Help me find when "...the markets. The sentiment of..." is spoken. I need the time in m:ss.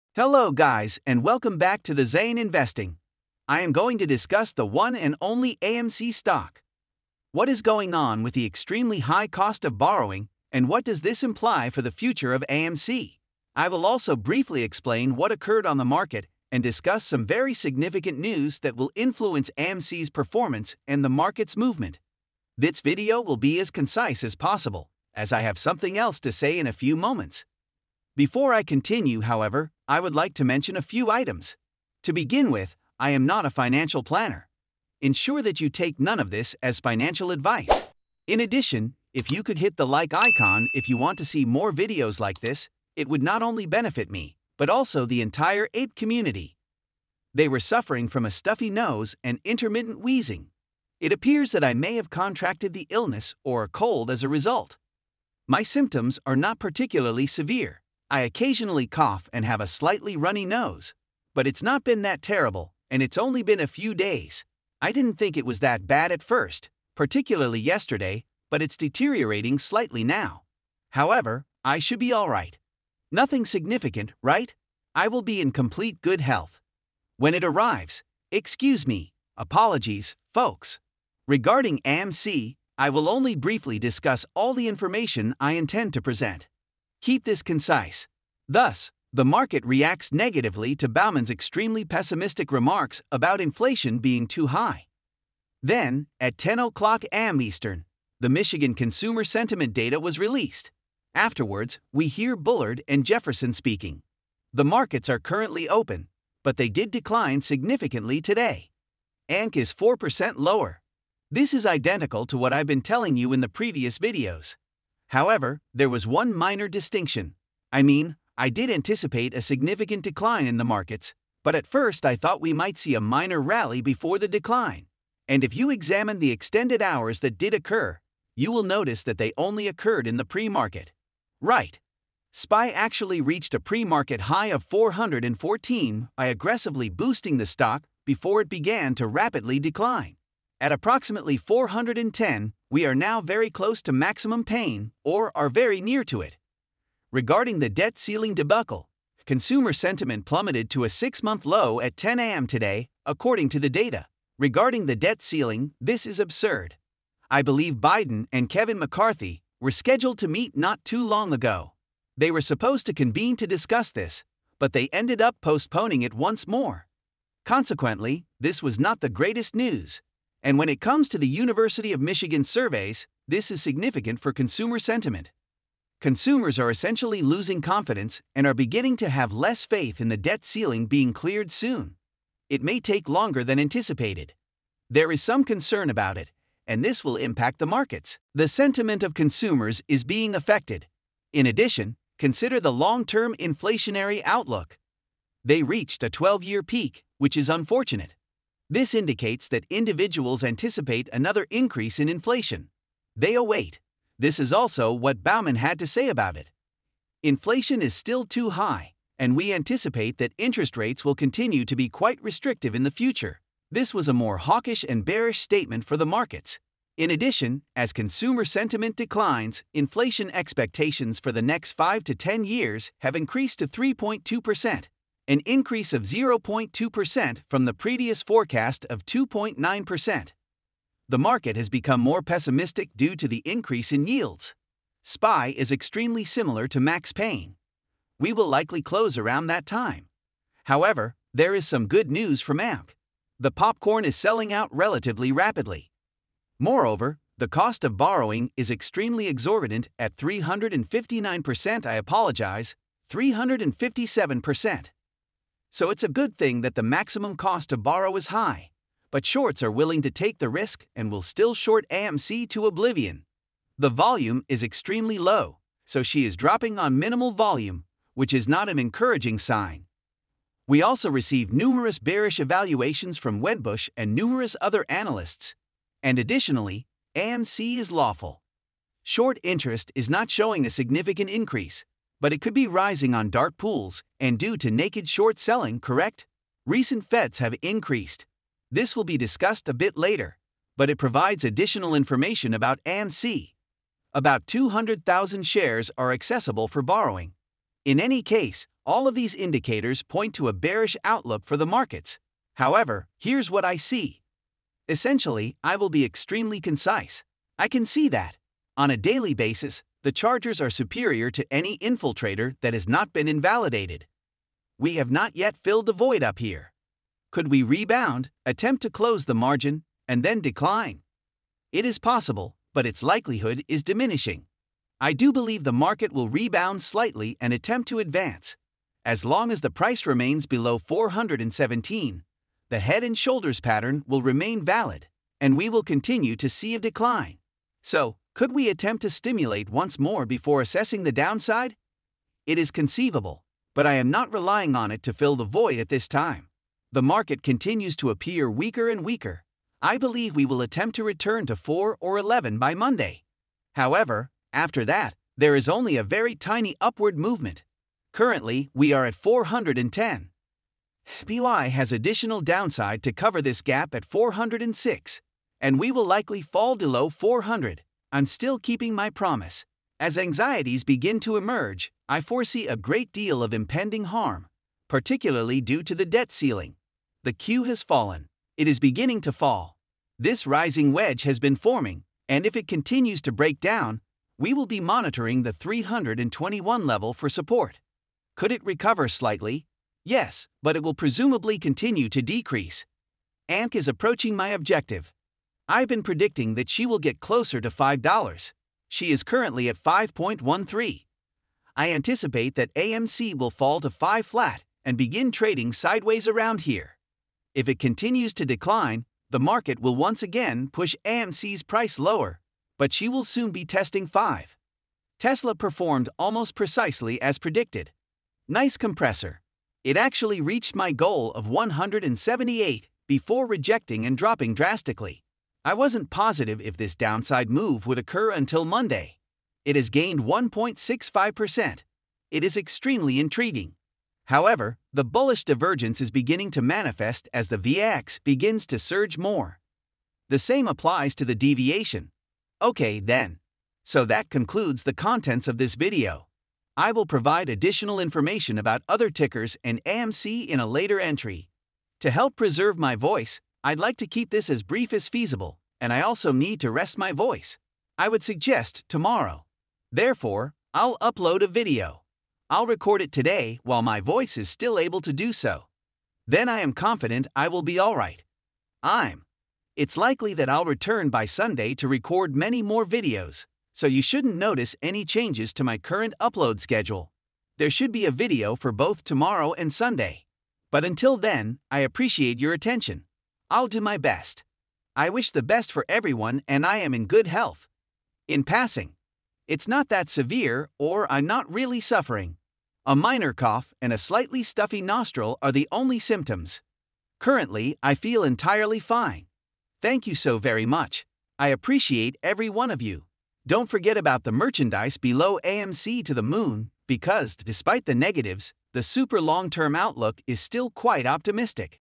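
3:07.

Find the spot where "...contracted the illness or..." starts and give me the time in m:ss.
0:52.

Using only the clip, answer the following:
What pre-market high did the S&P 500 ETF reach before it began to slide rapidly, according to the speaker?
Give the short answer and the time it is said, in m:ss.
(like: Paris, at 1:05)
414, at 2:14.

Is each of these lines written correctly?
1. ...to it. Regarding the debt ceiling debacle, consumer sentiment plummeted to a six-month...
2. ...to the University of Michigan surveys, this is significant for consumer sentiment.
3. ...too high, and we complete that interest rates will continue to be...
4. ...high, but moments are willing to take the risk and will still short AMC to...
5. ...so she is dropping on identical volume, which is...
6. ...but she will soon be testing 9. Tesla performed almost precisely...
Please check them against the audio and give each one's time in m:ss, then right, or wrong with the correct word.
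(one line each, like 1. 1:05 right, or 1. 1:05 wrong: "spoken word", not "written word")
1. 2:26 right
2. 2:51 right
3. 3:28 wrong: "anticipate", not "complete"
4. 4:18 wrong: "shorts", not "moments"
5. 4:25 wrong: "minimal", not "identical"
6. 6:52 wrong: "5", not "9".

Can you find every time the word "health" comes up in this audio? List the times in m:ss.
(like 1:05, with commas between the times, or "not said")
1:16, 8:07.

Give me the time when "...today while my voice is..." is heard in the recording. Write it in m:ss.
7:43.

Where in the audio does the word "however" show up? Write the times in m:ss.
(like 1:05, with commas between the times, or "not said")
0:29, 1:10, 1:55, 4:00, 5:02, 5:53, 7:14.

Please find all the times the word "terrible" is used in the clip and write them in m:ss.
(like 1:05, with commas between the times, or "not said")
1:02.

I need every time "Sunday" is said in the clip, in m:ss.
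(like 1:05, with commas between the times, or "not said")
7:51, 7:59.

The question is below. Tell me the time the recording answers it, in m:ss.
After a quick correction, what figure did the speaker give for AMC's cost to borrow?
4:13.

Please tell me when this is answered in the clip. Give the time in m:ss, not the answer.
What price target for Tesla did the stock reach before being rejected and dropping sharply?
7:01.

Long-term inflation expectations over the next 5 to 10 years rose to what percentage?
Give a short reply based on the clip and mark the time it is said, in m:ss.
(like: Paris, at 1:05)
3.2%, at 3:43.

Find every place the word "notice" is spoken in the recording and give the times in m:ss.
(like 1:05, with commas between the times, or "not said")
2:08, 7:54.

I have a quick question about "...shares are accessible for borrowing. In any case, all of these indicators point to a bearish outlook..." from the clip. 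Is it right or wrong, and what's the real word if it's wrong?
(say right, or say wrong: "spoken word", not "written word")
right.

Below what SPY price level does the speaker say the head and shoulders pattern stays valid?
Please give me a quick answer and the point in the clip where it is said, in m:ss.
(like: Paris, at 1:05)
417, at 5:30.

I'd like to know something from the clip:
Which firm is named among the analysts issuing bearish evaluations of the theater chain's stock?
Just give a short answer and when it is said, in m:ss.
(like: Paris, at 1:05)
Wedbush, at 4:33.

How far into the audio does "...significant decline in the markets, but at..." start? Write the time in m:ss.
1:59.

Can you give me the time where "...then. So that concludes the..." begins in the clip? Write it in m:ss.
7:22.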